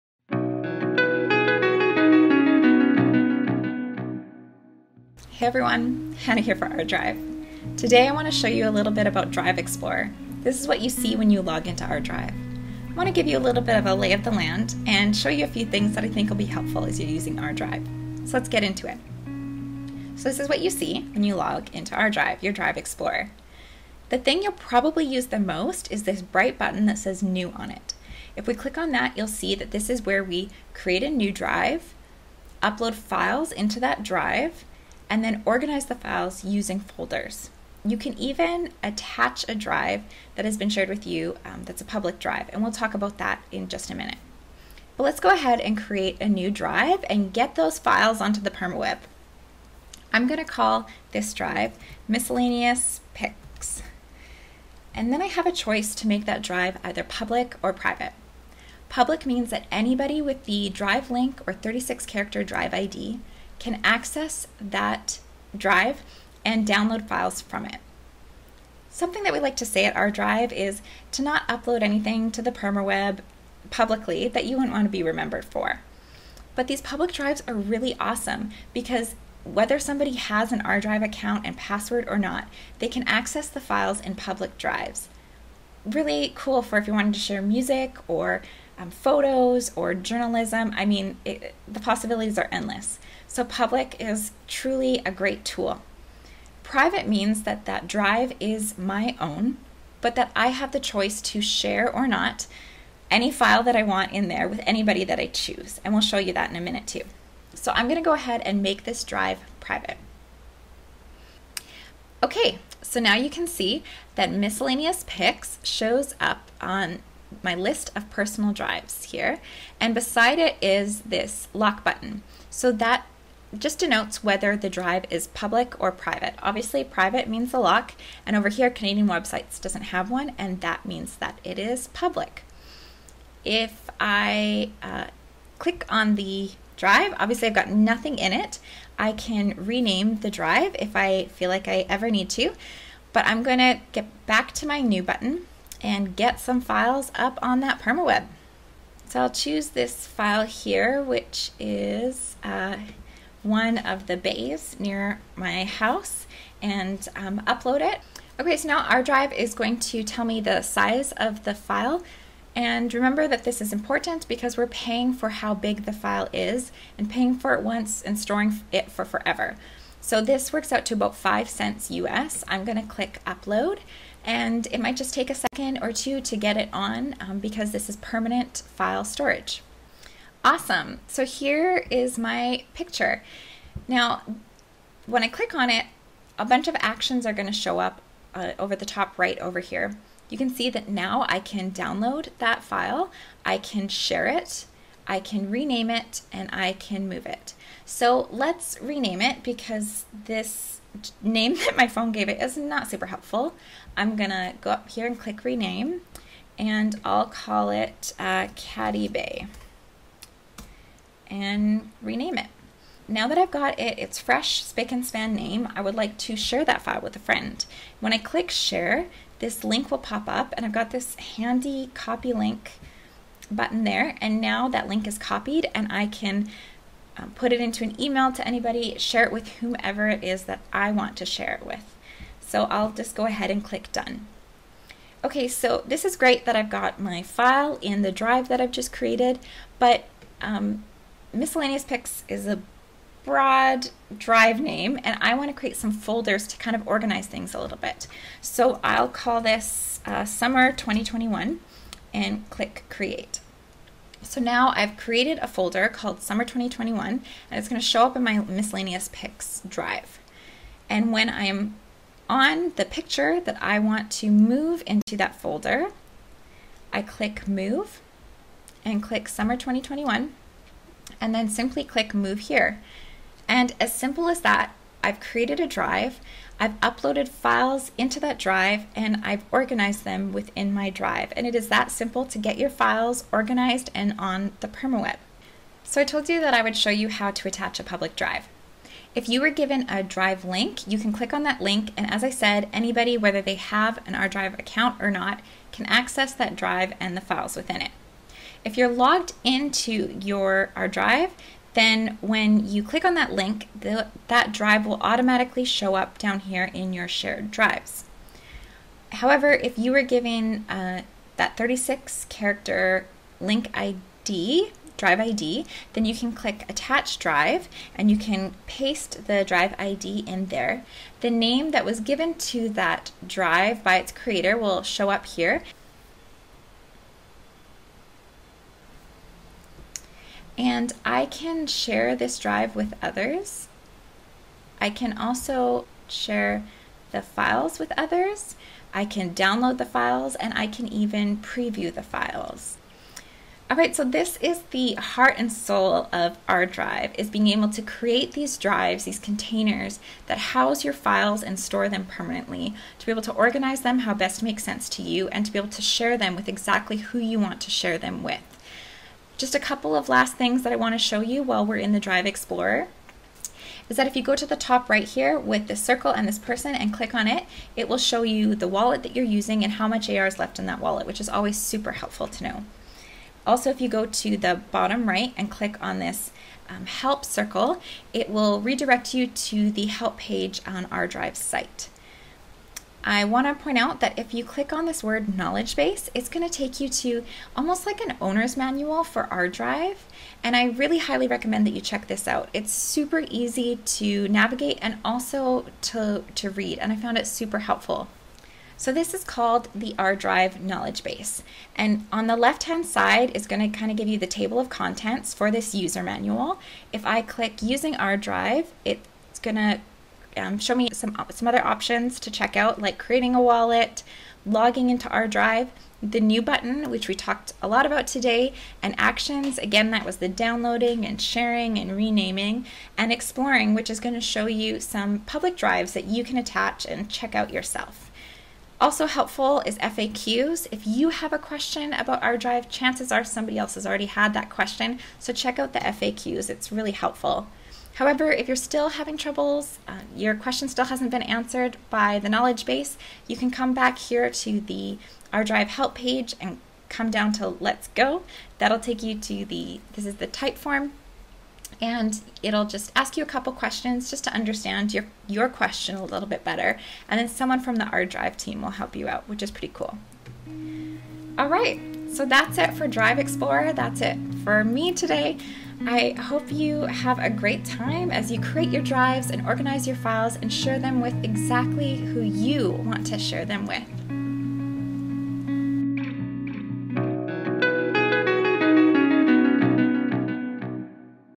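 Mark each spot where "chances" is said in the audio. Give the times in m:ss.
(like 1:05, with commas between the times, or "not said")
7:12.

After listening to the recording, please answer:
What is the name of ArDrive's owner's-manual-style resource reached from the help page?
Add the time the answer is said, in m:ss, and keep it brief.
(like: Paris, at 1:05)
ArDrive Knowledge Base, at 6:39.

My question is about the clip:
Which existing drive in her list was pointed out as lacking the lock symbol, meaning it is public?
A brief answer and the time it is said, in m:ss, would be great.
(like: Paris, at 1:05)
Canadian Websites, at 2:08.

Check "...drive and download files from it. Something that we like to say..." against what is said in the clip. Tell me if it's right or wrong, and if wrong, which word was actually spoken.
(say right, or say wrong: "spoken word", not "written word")
right.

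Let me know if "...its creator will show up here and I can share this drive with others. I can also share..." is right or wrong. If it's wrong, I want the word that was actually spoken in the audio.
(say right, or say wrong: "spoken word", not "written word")
right.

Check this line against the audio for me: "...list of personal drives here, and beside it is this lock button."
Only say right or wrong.
right.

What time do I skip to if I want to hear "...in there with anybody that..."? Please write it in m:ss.
1:44.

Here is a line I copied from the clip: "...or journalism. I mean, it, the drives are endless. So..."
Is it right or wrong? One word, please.
wrong.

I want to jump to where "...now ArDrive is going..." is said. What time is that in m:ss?
2:38.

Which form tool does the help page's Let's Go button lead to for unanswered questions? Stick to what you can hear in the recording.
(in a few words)
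Typeform.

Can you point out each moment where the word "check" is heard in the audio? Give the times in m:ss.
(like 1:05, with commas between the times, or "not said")
6:31, 6:52, 7:07, 7:15.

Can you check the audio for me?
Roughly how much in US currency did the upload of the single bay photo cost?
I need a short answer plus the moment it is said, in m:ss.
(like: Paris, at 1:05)
5 cents, at 2:51.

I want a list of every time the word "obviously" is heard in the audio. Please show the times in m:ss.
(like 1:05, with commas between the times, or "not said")
2:06, 2:17.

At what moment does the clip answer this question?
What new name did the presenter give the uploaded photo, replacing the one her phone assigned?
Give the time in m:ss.
3:28.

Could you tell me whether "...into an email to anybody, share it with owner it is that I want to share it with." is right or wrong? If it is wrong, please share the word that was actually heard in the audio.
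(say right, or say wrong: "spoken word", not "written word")
wrong: "whomever", not "owner".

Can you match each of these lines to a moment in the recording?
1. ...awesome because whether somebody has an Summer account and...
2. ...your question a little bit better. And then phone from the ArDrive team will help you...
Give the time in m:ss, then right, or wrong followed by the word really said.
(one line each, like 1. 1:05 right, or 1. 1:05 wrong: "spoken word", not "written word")
1. 1:17 wrong: "ArDrive", not "Summer"
2. 7:35 wrong: "someone", not "phone".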